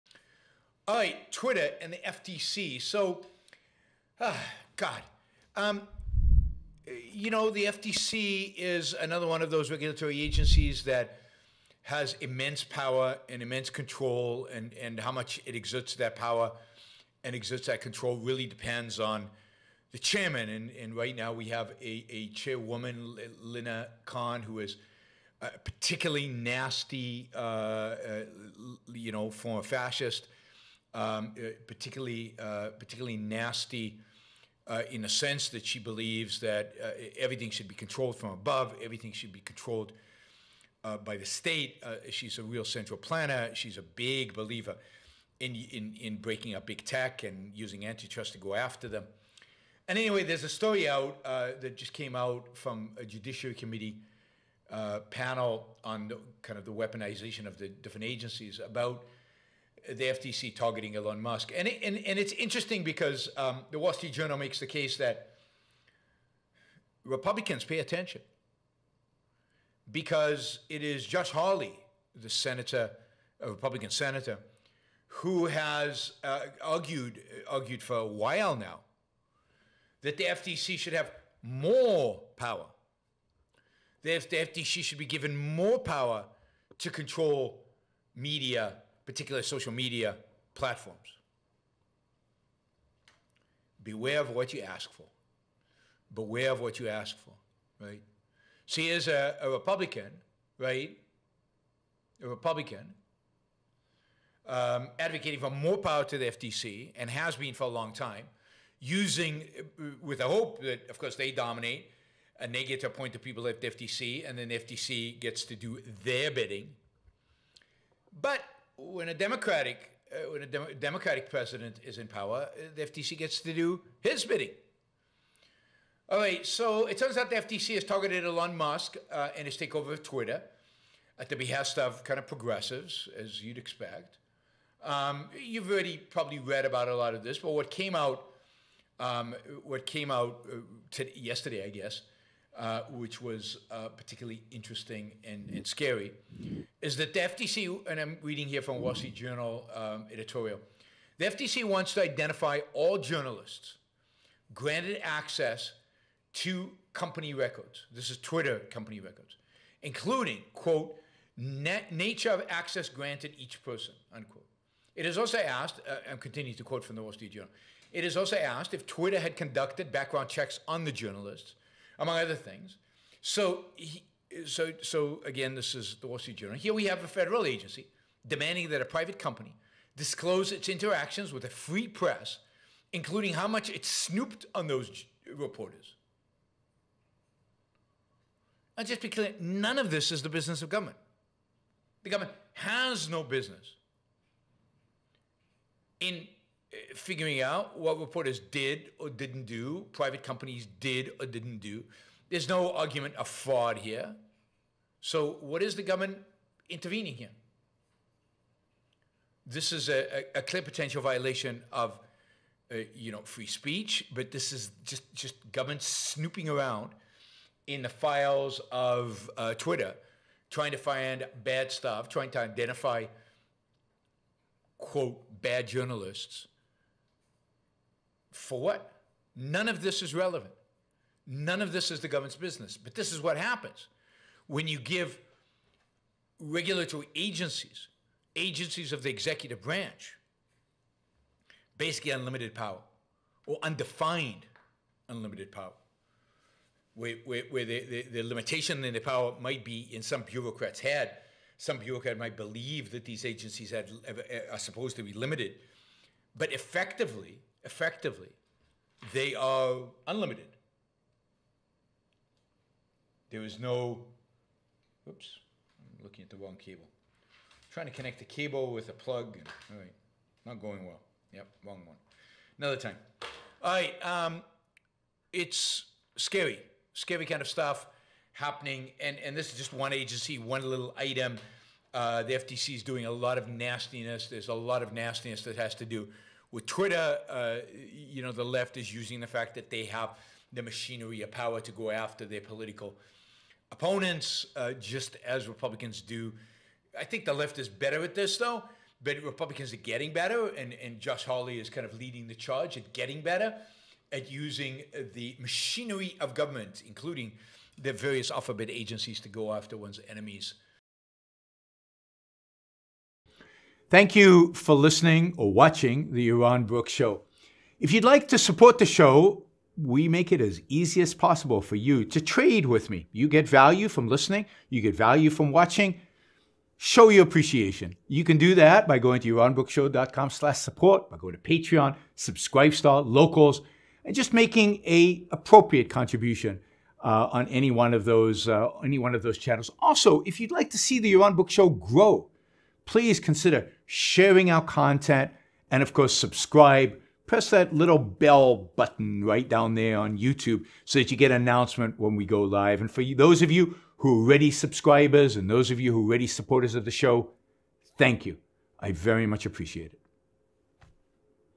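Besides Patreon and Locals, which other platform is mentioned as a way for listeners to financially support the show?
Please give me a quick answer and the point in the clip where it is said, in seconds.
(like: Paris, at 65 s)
Subscribestar, at 332 s.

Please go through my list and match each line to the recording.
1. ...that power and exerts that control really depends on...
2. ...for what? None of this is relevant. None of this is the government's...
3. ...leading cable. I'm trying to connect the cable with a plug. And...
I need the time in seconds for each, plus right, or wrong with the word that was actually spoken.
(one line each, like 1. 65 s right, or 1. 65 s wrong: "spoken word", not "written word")
1. 15 s right
2. 228 s right
3. 266 s wrong: "wrong", not "leading".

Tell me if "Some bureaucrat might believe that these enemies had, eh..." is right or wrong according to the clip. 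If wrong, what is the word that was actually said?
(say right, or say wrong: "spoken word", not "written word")
wrong: "agencies", not "enemies".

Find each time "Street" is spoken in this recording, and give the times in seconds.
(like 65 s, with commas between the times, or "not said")
63 s, 148 s, 167 s, 176 s.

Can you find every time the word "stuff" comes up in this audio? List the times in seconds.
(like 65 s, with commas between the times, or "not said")
221 s, 277 s.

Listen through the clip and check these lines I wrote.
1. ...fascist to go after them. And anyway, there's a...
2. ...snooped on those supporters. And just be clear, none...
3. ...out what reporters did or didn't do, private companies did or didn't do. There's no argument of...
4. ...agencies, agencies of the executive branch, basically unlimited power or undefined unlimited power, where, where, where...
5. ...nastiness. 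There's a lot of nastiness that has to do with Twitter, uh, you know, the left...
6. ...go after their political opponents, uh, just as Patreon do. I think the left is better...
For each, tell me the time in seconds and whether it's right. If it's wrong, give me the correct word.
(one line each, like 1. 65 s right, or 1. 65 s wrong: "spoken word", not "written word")
1. 47 s wrong: "antitrust", not "fascist"
2. 183 s wrong: "reporters", not "supporters"
3. 197 s right
4. 237 s right
5. 283 s right
6. 291 s wrong: "Republicans", not "Patreon".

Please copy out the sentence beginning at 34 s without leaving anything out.
Uh, in the sense that she believes that everything should be controlled from above, everything should be controlled by the state.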